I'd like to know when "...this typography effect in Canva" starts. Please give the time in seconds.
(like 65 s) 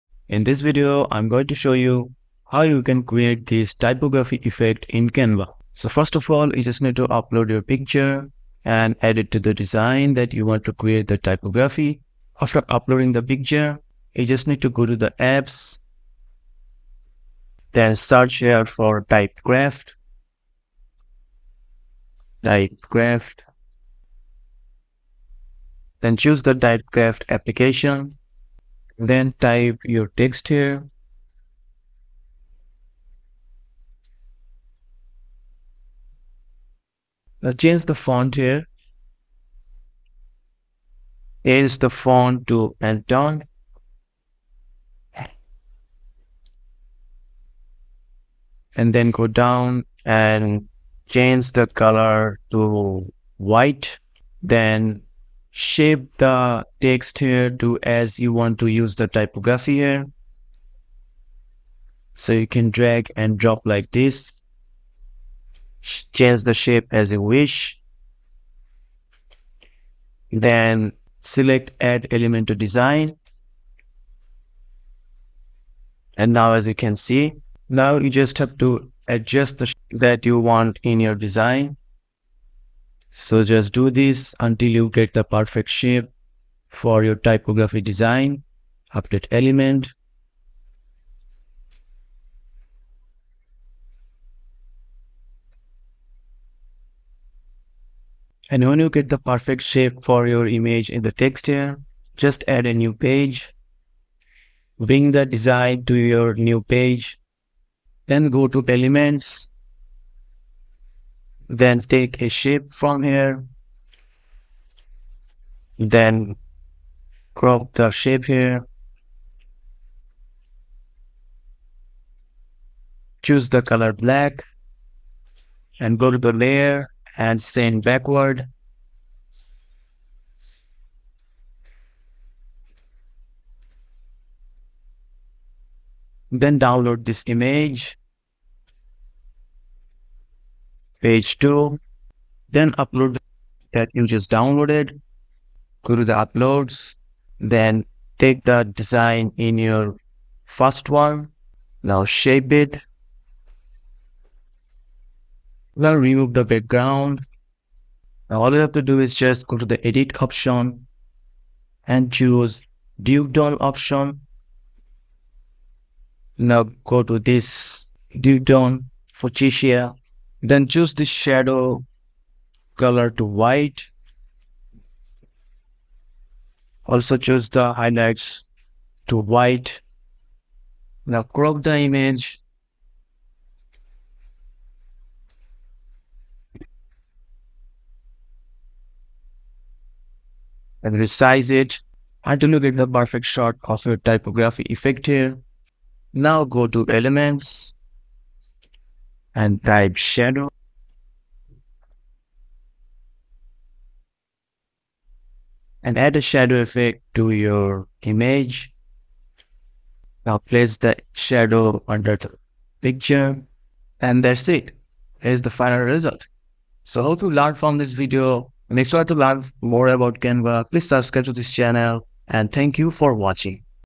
3 s.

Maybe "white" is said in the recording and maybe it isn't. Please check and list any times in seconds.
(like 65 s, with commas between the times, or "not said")
53 s, 173 s, 179 s.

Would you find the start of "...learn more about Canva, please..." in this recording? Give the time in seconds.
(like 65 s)
219 s.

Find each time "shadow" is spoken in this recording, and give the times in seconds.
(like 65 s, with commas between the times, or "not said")
171 s, 199 s, 206 s, 211 s.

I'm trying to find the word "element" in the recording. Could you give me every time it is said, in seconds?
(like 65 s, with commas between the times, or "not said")
72 s, 89 s, 108 s, 196 s.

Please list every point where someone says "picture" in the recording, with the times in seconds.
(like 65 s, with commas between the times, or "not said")
7 s, 13 s, 212 s.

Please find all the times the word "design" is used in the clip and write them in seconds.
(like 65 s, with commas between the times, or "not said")
9 s, 72 s, 81 s, 87 s, 105 s, 148 s.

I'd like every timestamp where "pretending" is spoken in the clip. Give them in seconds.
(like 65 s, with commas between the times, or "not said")
not said.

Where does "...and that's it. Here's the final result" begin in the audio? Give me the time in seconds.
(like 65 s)
213 s.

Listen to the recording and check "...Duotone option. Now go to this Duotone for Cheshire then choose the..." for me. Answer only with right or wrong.
right.